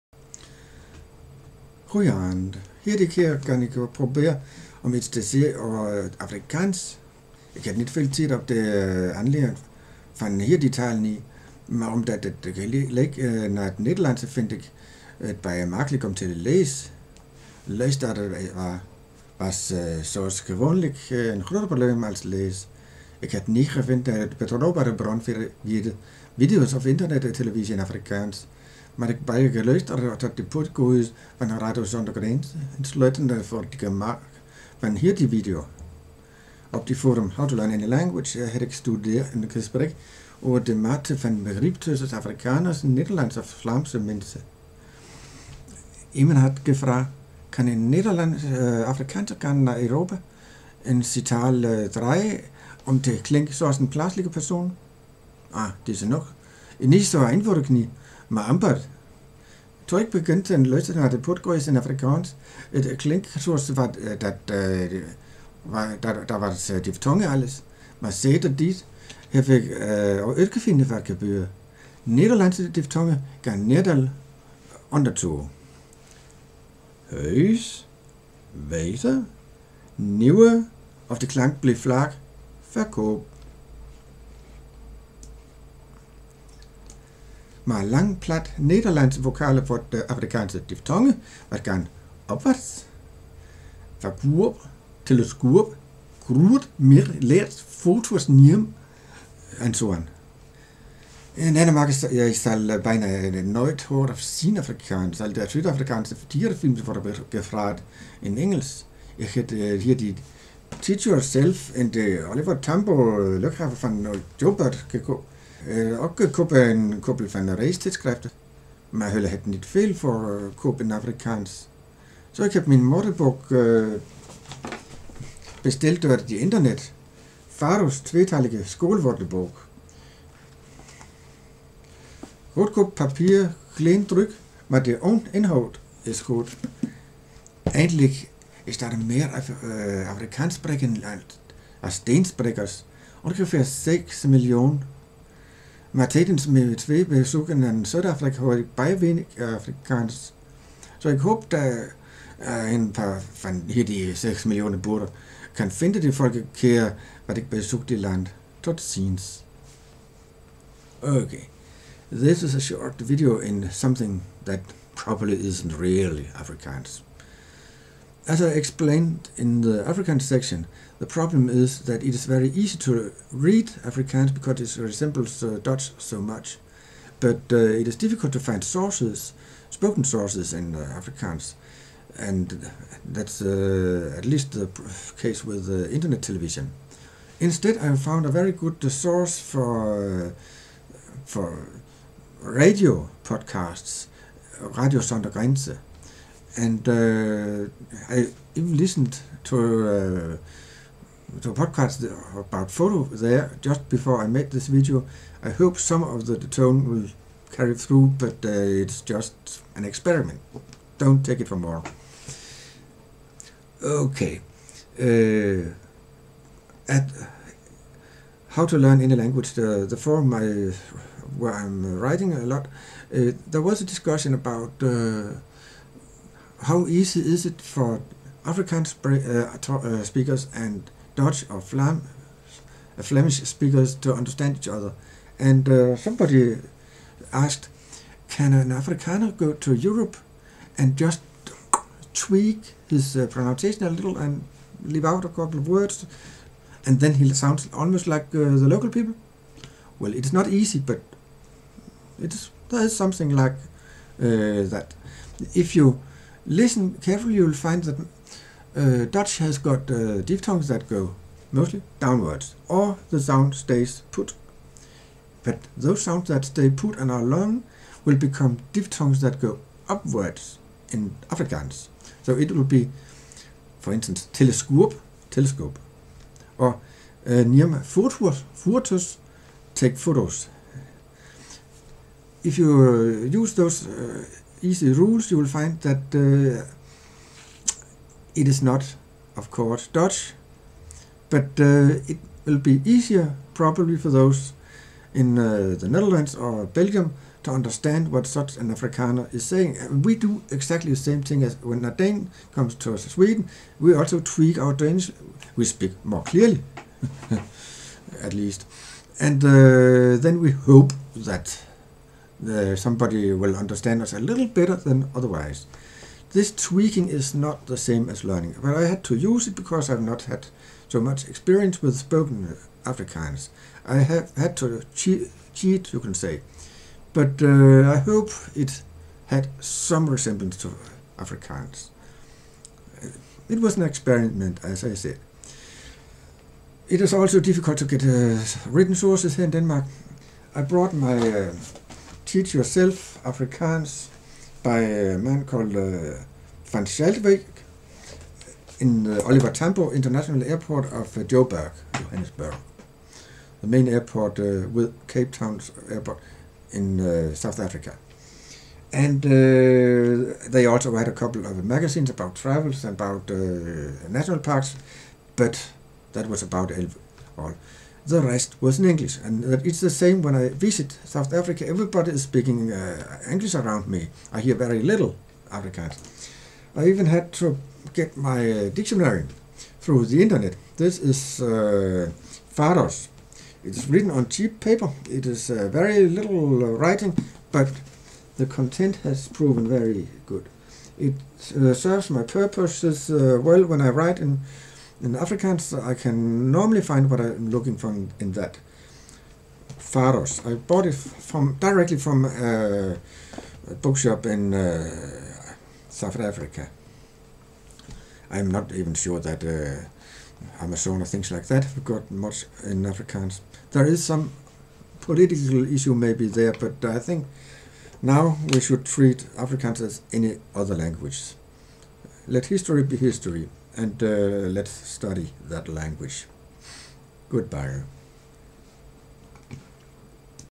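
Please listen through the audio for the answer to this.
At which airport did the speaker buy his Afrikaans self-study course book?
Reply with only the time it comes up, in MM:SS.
05:49.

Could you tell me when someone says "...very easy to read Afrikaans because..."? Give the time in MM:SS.
02:52.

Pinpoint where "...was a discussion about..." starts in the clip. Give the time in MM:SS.
03:43.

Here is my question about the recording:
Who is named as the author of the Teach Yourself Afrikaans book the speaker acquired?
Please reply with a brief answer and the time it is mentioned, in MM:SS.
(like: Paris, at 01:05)
Van Schalkwyk, at 05:46.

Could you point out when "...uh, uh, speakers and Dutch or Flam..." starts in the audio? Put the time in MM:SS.
03:49.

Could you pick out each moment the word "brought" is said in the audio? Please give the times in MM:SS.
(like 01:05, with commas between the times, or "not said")
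05:40.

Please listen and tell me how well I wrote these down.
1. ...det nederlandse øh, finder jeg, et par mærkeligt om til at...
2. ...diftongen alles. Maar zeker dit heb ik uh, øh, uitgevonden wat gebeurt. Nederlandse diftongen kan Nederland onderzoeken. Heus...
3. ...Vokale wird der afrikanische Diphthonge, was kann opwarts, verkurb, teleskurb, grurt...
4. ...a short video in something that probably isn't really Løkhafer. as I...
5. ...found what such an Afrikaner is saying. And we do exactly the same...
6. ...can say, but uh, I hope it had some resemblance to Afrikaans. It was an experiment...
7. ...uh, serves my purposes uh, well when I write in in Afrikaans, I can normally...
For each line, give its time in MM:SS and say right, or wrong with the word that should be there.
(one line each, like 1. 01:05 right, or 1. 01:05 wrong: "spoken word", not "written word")
1. 00:13 right
2. 01:06 right
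3. 01:29 right
4. 02:42 wrong: "Afrikaans", not "Løkhafer"
5. 04:57 wrong: "understand", not "found"
6. 05:25 right
7. 06:31 right.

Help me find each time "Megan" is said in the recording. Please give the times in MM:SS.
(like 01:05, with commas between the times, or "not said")
not said.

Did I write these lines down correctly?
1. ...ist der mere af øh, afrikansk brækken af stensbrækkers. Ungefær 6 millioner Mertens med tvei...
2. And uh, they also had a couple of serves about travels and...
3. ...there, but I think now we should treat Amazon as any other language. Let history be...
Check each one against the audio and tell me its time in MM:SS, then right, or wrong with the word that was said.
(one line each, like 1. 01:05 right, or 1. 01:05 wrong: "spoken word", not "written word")
1. 02:18 right
2. 05:58 wrong: "magazines", not "serves"
3. 06:56 wrong: "Afrikaans", not "Amazon".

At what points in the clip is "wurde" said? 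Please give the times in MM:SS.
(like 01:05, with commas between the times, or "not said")
01:46.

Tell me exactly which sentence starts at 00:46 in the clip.
Iemand had gevraagd, kan een Nederlandse äh, eh, Afrikaner kan naar Europa?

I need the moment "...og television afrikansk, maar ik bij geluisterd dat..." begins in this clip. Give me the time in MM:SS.
00:27.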